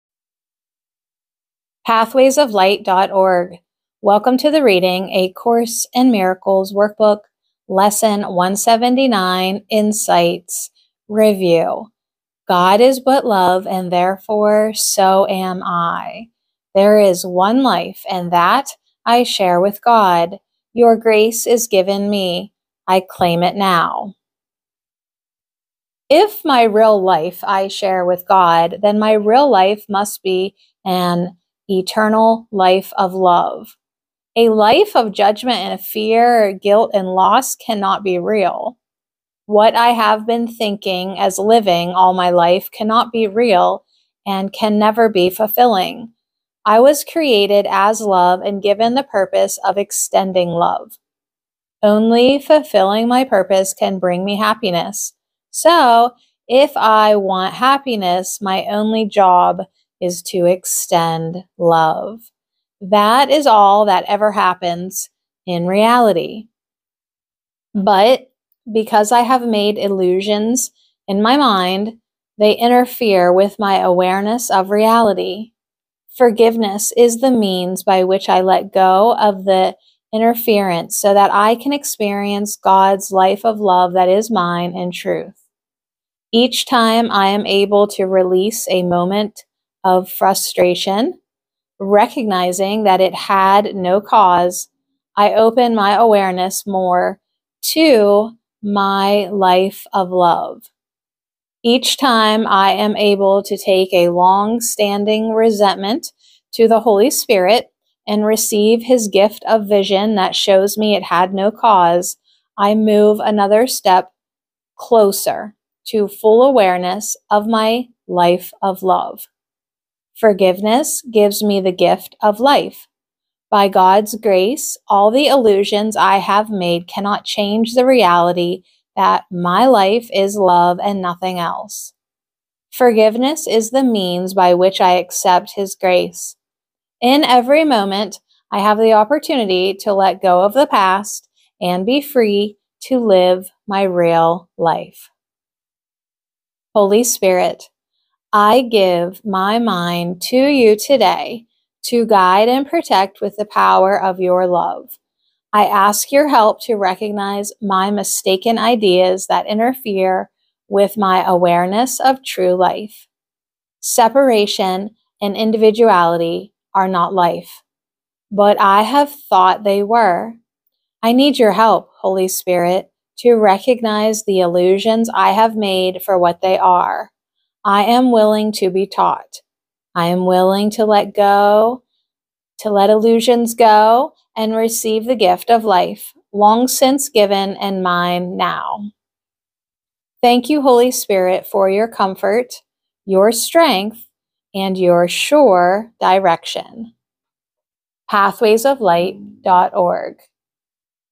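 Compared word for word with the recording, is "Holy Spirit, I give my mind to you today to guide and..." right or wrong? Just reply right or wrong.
right.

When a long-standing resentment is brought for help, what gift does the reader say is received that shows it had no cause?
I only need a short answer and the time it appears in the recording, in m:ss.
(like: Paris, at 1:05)
vision, at 1:49.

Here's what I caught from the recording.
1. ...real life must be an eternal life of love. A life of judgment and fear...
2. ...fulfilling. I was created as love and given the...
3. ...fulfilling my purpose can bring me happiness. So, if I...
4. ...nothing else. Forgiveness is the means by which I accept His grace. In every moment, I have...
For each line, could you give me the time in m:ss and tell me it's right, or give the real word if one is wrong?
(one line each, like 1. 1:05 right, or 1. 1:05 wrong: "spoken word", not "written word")
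1. 0:29 right
2. 0:45 right
3. 0:52 right
4. 2:11 right.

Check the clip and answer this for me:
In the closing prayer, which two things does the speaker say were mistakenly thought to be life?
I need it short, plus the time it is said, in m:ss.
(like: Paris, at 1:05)
Separation and individuality, at 2:43.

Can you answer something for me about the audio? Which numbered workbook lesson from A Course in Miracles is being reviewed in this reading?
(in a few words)
179.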